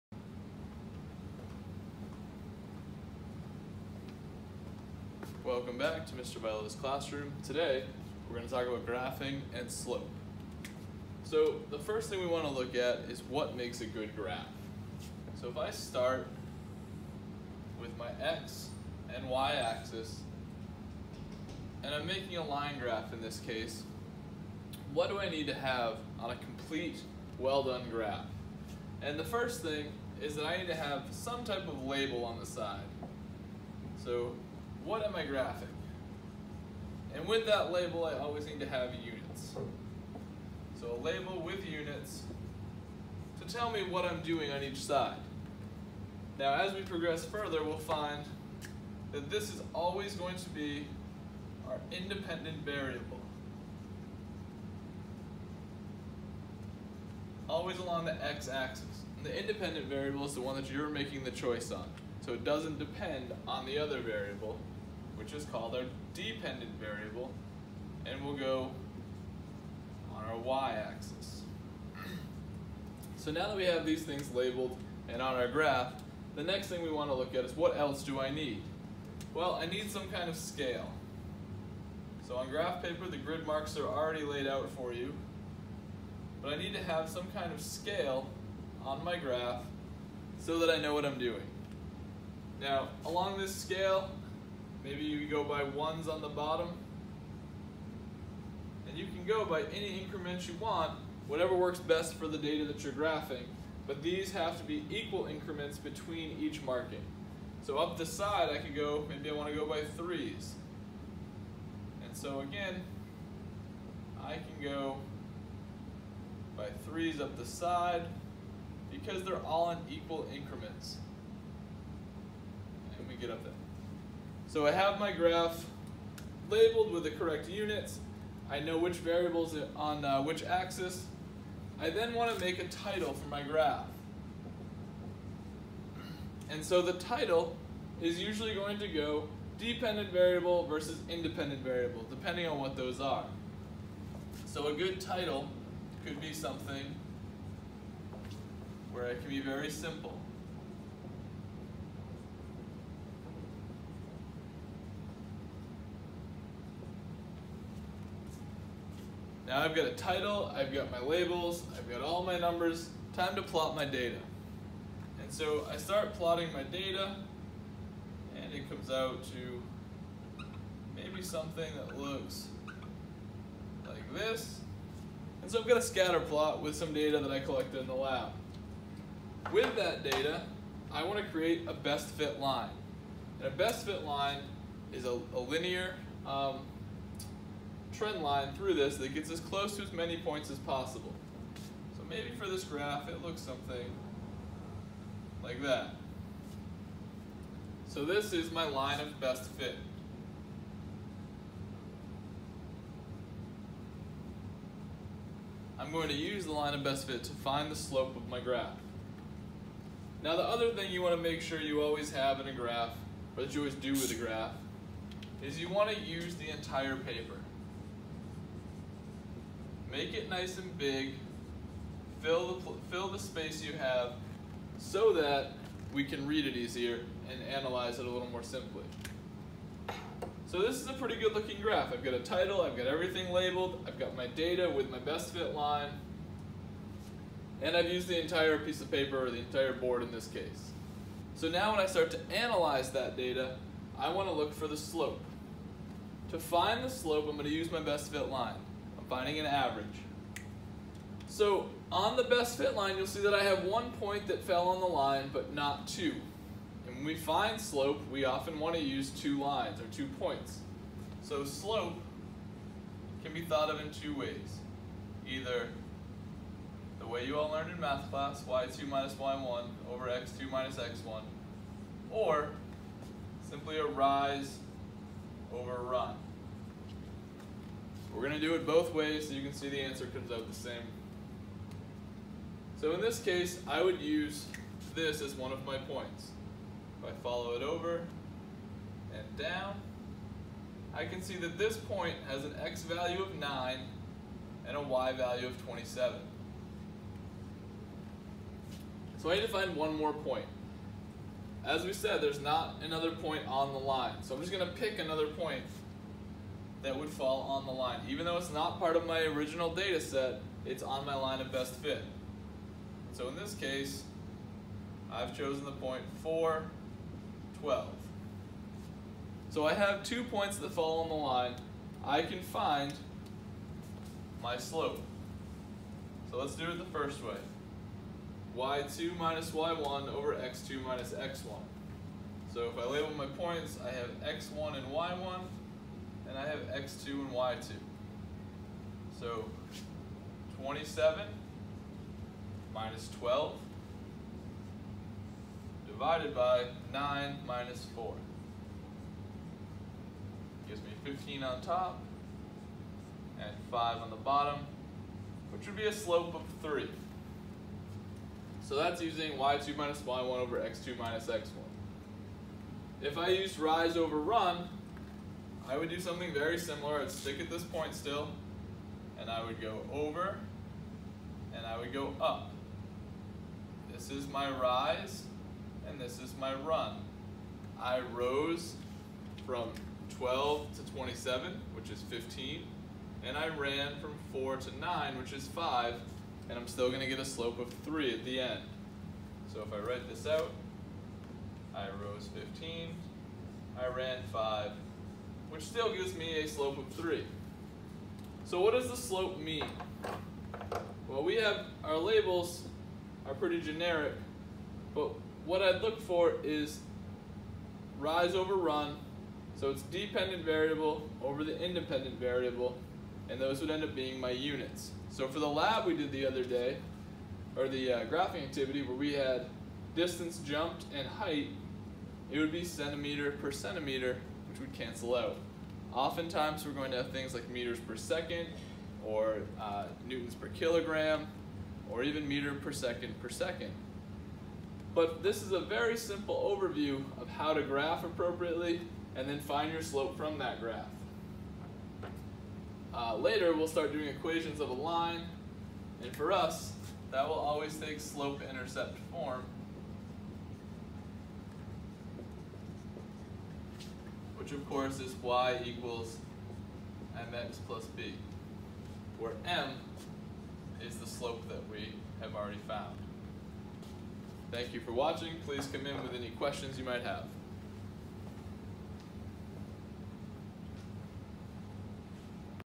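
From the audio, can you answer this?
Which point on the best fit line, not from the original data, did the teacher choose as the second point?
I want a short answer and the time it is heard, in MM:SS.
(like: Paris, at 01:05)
4, 12, at 05:16.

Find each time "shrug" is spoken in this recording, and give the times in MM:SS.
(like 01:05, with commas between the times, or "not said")
not said.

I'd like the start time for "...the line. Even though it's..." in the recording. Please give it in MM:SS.
05:07.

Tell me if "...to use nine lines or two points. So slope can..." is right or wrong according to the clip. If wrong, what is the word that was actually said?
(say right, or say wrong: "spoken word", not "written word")
wrong: "two", not "nine".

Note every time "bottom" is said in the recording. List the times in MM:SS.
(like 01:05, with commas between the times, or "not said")
01:36, 05:54.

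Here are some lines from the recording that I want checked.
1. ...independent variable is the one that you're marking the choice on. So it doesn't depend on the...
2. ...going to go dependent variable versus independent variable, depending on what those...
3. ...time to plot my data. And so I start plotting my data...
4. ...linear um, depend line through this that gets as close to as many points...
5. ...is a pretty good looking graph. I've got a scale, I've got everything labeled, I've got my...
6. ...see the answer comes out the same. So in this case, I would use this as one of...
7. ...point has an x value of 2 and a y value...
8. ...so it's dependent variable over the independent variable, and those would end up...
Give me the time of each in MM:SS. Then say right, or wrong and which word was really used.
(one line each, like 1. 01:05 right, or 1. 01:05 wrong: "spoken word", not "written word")
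1. 00:59 wrong: "making", not "marking"
2. 02:18 right
3. 02:43 right
4. 03:05 wrong: "trend", not "depend"
5. 03:50 wrong: "title", not "scale"
6. 04:39 right
7. 04:51 wrong: "9", not "2"
8. 06:49 right.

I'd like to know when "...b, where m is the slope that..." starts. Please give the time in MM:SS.
07:37.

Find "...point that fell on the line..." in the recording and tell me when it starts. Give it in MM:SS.
04:13.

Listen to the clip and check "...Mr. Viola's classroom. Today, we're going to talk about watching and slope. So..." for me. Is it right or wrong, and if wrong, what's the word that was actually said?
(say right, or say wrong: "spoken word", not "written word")
wrong: "graphing", not "watching".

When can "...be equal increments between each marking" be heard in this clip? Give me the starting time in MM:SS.
01:44.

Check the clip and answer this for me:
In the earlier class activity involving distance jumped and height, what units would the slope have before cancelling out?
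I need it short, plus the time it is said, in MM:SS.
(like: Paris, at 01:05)
centimeter per centimeter, at 07:02.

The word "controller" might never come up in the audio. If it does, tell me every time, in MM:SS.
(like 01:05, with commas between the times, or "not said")
not said.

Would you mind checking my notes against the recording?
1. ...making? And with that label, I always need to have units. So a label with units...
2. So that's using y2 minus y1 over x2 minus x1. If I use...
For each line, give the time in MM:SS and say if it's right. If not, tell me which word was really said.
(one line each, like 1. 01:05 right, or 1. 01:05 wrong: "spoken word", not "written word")
1. 00:35 wrong: "graphing", not "making"
2. 05:58 right.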